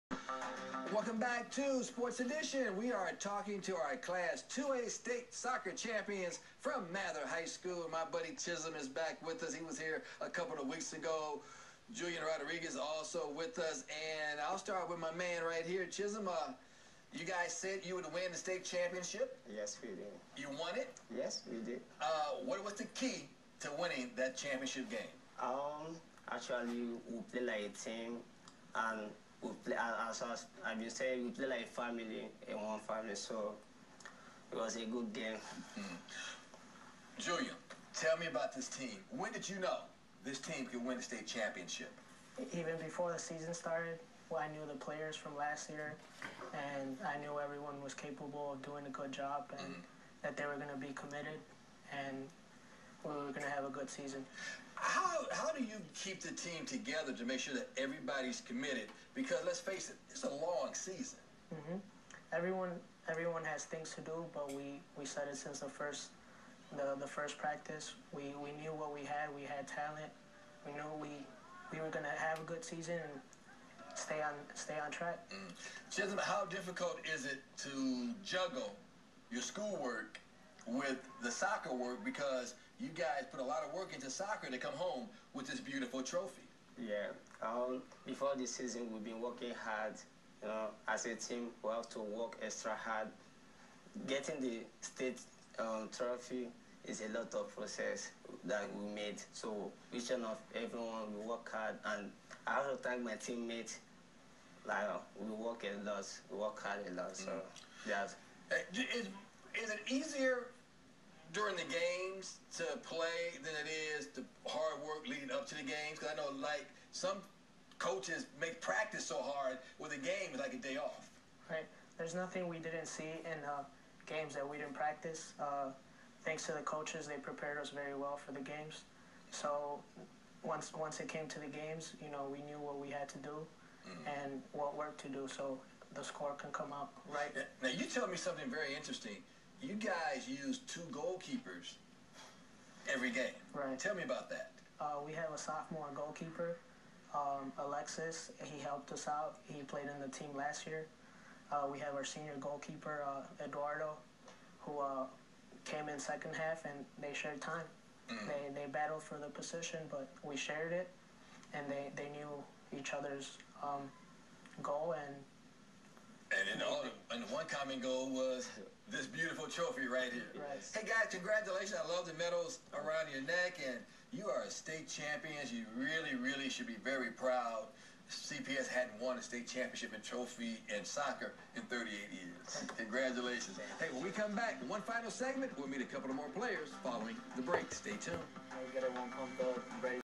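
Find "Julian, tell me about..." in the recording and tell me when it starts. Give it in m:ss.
0:37.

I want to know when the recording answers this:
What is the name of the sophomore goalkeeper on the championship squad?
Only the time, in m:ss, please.
2:27.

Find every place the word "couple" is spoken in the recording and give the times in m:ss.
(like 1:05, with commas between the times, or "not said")
0:10, 3:05.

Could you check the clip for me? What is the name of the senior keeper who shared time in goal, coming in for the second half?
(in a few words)
Eduardo.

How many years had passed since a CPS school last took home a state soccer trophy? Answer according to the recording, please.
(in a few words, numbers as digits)
38.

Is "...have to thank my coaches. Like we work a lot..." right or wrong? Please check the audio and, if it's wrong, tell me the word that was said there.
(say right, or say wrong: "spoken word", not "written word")
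wrong: "teammates", not "coaches".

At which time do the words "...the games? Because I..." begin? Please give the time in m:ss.
1:55.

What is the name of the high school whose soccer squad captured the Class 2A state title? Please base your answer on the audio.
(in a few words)
Mather High School.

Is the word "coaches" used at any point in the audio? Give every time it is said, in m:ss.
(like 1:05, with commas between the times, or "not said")
1:57, 2:06.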